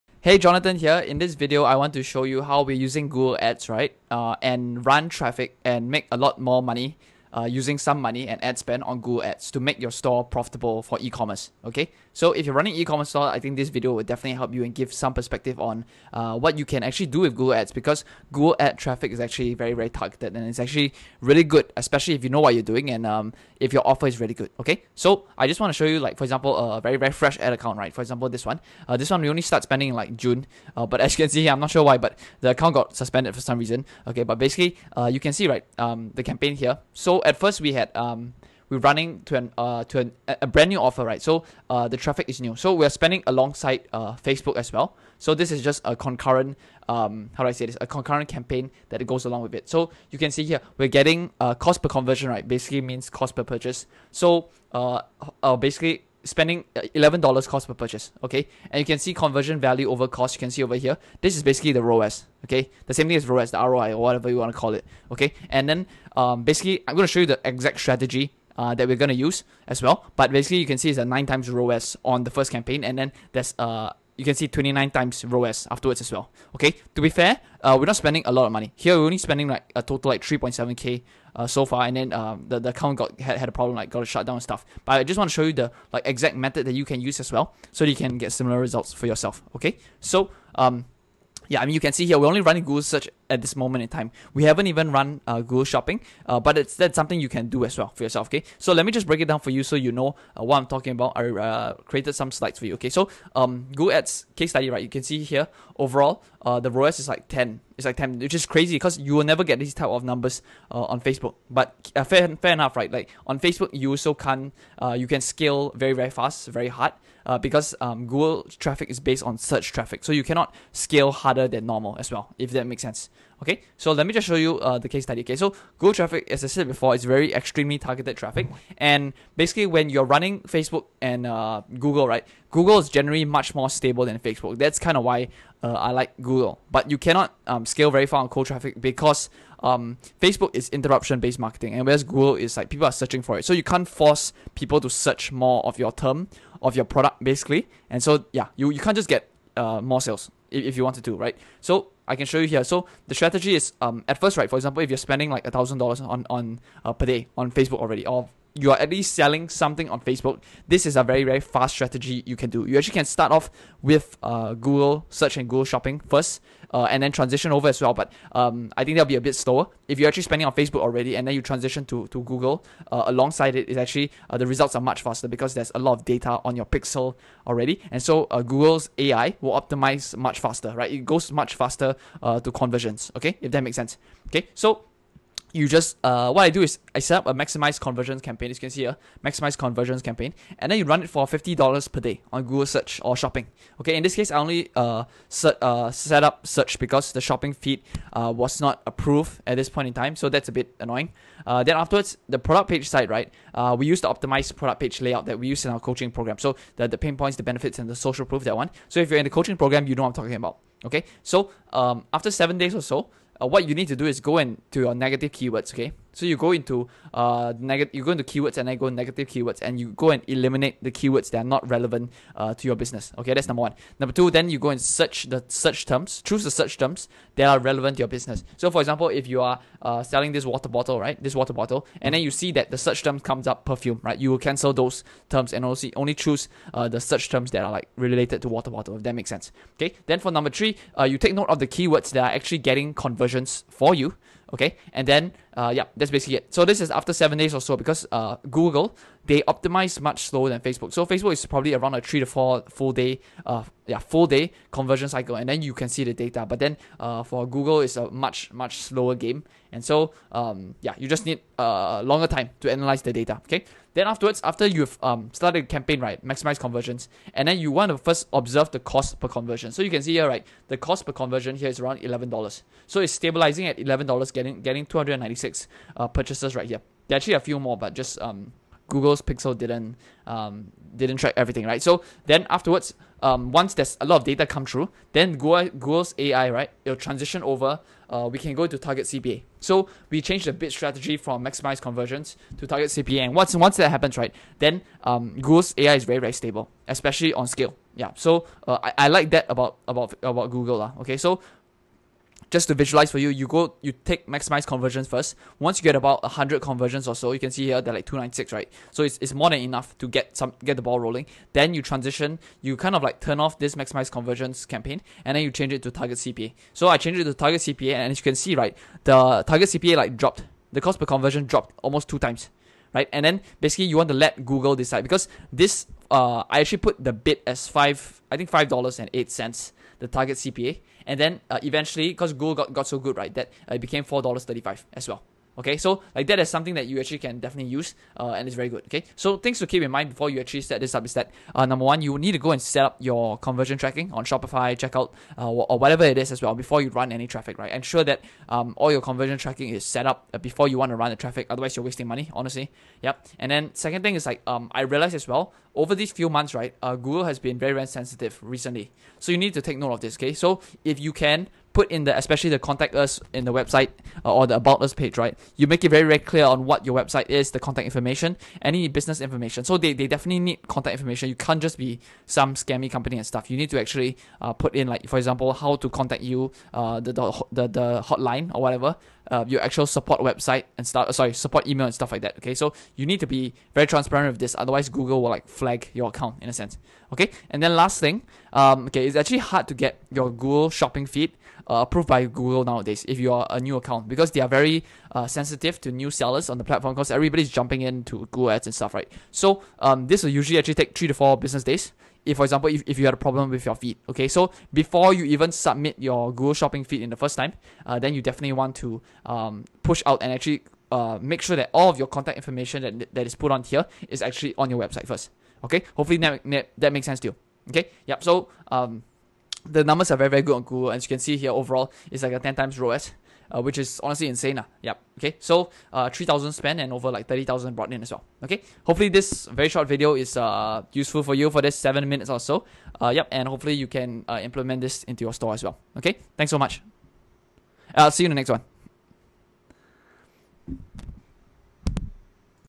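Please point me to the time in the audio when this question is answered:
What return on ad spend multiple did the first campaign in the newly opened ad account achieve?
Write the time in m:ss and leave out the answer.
1:11.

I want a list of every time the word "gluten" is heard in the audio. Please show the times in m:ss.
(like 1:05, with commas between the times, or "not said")
not said.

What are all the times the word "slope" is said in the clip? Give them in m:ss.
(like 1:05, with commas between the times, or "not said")
not said.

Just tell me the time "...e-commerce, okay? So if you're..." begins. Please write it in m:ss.
0:11.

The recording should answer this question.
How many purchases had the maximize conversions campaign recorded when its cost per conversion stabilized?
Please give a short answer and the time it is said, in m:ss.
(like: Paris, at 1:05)
296, at 4:34.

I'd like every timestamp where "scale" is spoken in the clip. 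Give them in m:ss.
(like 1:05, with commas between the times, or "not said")
1:55, 2:00, 2:17, 4:57.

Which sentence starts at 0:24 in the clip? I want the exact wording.
So I just want to show you like, for example, a very, very fresh ad account, right?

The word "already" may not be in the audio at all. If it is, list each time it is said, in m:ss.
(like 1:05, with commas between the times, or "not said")
2:37, 2:50, 2:57.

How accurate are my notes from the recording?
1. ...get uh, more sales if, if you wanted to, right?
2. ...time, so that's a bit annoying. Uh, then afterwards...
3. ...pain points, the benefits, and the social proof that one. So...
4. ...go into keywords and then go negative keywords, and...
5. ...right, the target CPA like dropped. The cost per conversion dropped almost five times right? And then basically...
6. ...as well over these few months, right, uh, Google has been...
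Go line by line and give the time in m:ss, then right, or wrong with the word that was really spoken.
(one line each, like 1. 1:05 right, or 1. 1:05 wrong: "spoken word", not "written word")
1. 2:29 right
2. 3:19 right
3. 3:26 right
4. 3:38 right
5. 5:18 wrong: "two", not "five"
6. 5:55 right.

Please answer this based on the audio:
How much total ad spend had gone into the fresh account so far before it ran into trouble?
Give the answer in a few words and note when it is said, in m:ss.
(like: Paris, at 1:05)
3.7k, at 1:20.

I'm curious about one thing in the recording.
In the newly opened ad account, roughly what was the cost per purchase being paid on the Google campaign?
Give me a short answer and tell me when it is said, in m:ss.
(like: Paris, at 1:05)
$11, at 0:56.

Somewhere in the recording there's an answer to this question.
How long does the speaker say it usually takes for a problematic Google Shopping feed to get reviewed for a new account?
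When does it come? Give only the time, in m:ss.
6:40.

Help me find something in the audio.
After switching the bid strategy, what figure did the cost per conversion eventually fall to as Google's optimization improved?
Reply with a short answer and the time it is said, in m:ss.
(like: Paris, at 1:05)
$4.35, at 5:34.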